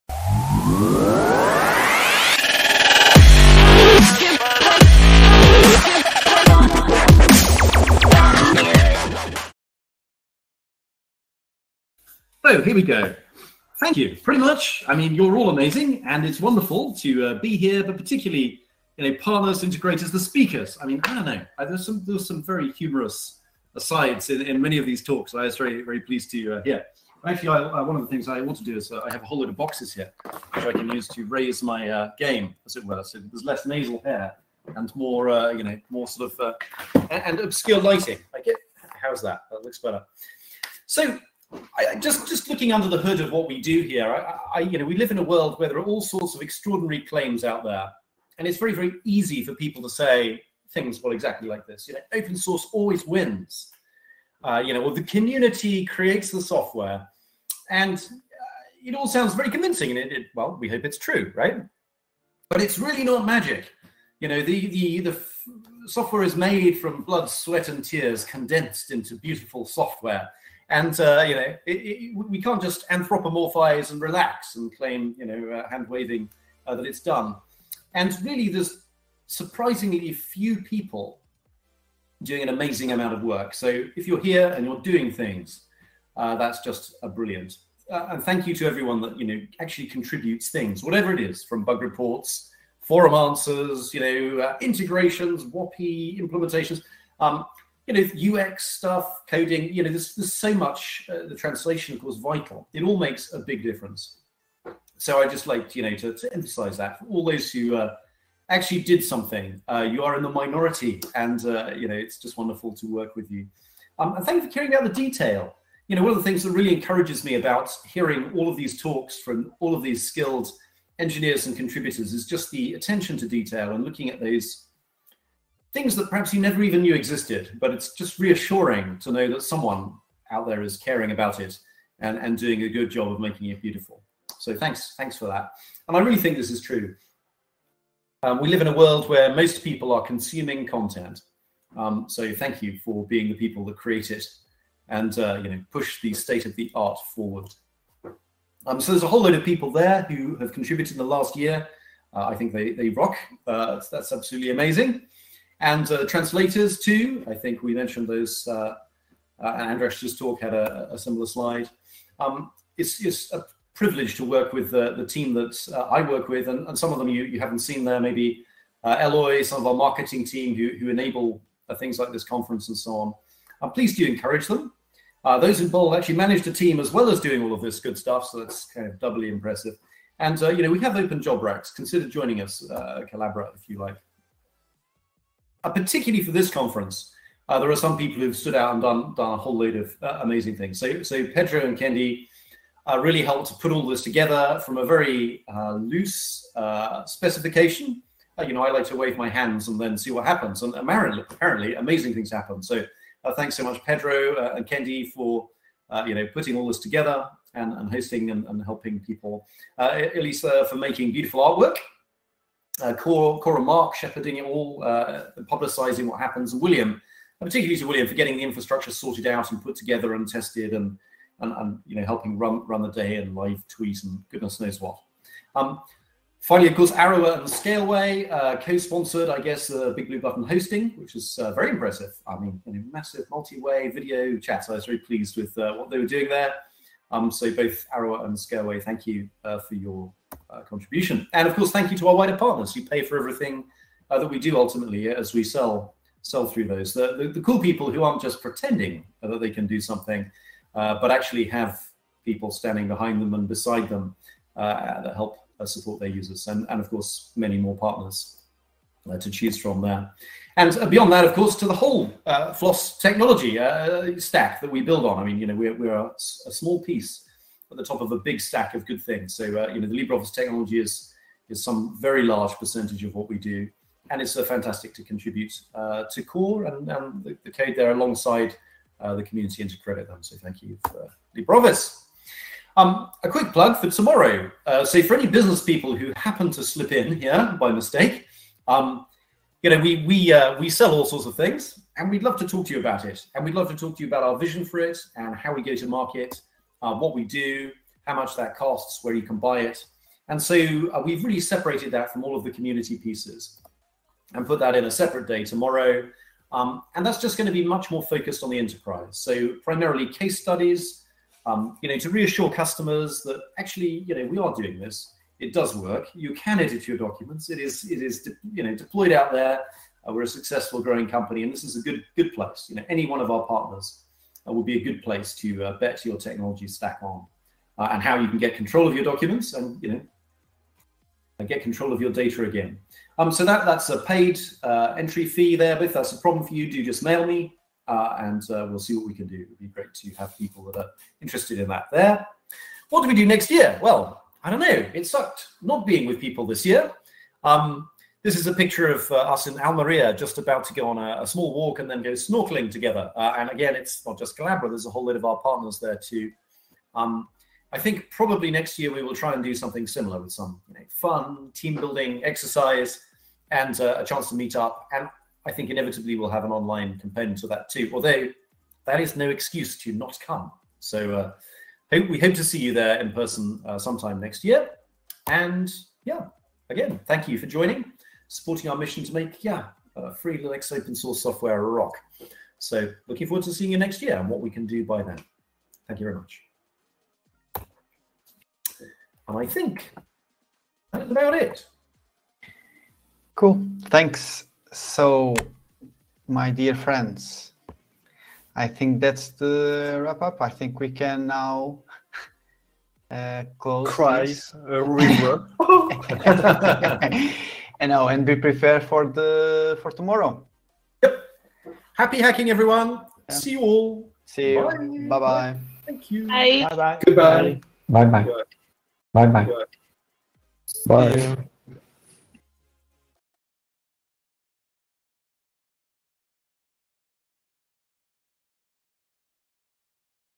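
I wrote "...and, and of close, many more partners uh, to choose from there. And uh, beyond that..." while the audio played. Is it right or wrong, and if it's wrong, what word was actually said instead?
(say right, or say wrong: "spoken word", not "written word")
wrong: "course", not "close".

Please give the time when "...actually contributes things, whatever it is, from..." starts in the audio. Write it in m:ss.
1:29.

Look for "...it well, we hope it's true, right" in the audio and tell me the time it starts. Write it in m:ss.
1:00.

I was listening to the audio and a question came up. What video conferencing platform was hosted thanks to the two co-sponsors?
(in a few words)
Big Blue Button.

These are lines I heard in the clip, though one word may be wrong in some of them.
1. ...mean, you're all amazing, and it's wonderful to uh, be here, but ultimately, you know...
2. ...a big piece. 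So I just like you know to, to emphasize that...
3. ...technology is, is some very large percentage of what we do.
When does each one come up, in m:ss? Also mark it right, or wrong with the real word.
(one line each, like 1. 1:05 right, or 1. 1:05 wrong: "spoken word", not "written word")
1. 0:14 wrong: "particularly", not "ultimately"
2. 1:43 wrong: "difference", not "piece"
3. 4:30 right.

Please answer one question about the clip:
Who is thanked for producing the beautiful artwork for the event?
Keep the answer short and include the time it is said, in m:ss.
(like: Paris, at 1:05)
Elisa, at 3:29.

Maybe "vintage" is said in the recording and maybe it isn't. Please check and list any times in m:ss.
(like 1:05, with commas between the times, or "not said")
not said.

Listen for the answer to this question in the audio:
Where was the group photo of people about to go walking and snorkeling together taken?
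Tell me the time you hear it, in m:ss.
5:49.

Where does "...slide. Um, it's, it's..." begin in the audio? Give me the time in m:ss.
2:41.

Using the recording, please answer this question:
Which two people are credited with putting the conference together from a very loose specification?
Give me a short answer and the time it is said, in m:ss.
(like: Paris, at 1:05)
Pedro and Kendi, at 3:11.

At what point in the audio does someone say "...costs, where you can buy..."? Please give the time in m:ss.
4:58.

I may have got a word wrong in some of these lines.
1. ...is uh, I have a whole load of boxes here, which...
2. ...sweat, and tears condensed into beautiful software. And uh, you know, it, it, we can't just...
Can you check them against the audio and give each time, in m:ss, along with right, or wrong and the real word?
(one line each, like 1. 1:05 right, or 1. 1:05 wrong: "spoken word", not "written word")
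1. 0:28 right
2. 1:07 right.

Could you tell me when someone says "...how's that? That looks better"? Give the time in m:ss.
0:38.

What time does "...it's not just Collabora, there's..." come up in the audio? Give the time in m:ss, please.
5:53.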